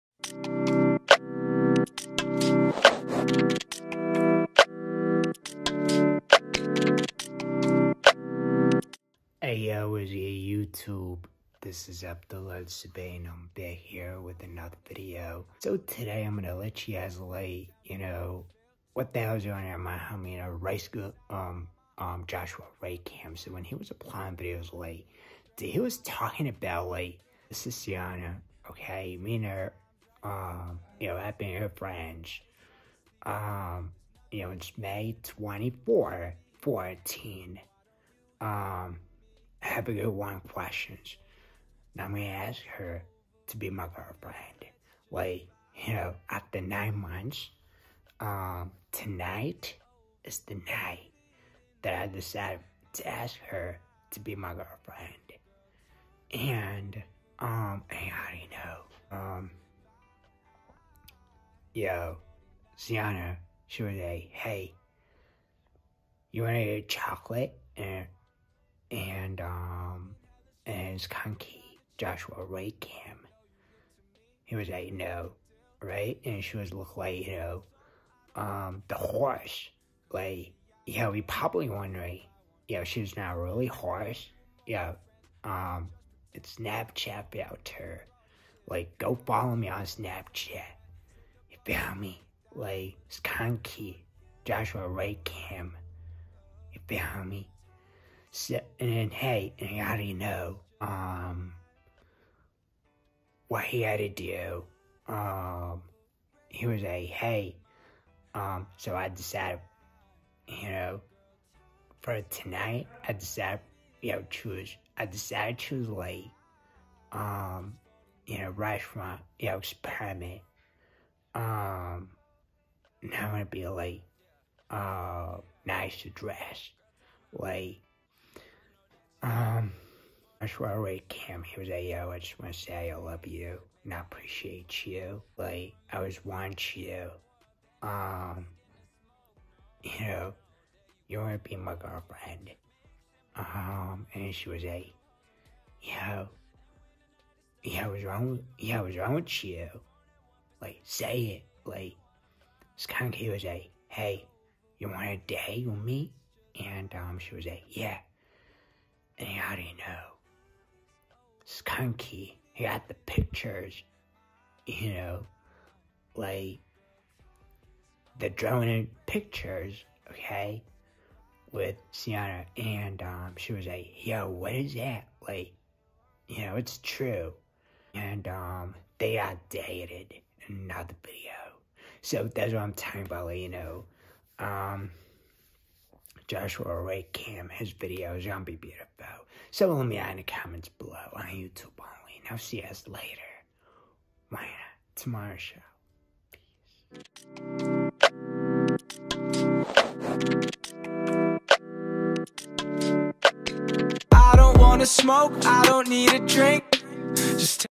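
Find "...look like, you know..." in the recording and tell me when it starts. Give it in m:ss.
1:16.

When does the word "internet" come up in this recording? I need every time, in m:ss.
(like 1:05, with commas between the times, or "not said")
not said.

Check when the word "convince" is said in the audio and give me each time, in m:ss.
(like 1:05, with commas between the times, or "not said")
not said.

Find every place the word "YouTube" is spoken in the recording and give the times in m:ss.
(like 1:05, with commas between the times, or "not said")
0:10, 3:11.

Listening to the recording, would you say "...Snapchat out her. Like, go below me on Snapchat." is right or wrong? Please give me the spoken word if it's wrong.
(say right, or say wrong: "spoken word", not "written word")
wrong: "follow", not "below".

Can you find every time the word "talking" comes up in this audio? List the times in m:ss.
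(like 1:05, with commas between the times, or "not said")
0:25, 3:02.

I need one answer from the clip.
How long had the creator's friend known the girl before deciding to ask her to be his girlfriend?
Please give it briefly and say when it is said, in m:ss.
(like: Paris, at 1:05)
9 months, at 0:46.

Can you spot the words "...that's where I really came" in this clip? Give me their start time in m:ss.
2:10.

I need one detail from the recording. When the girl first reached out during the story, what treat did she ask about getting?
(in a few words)
Chocolate.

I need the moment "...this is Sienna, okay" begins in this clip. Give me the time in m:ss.
0:27.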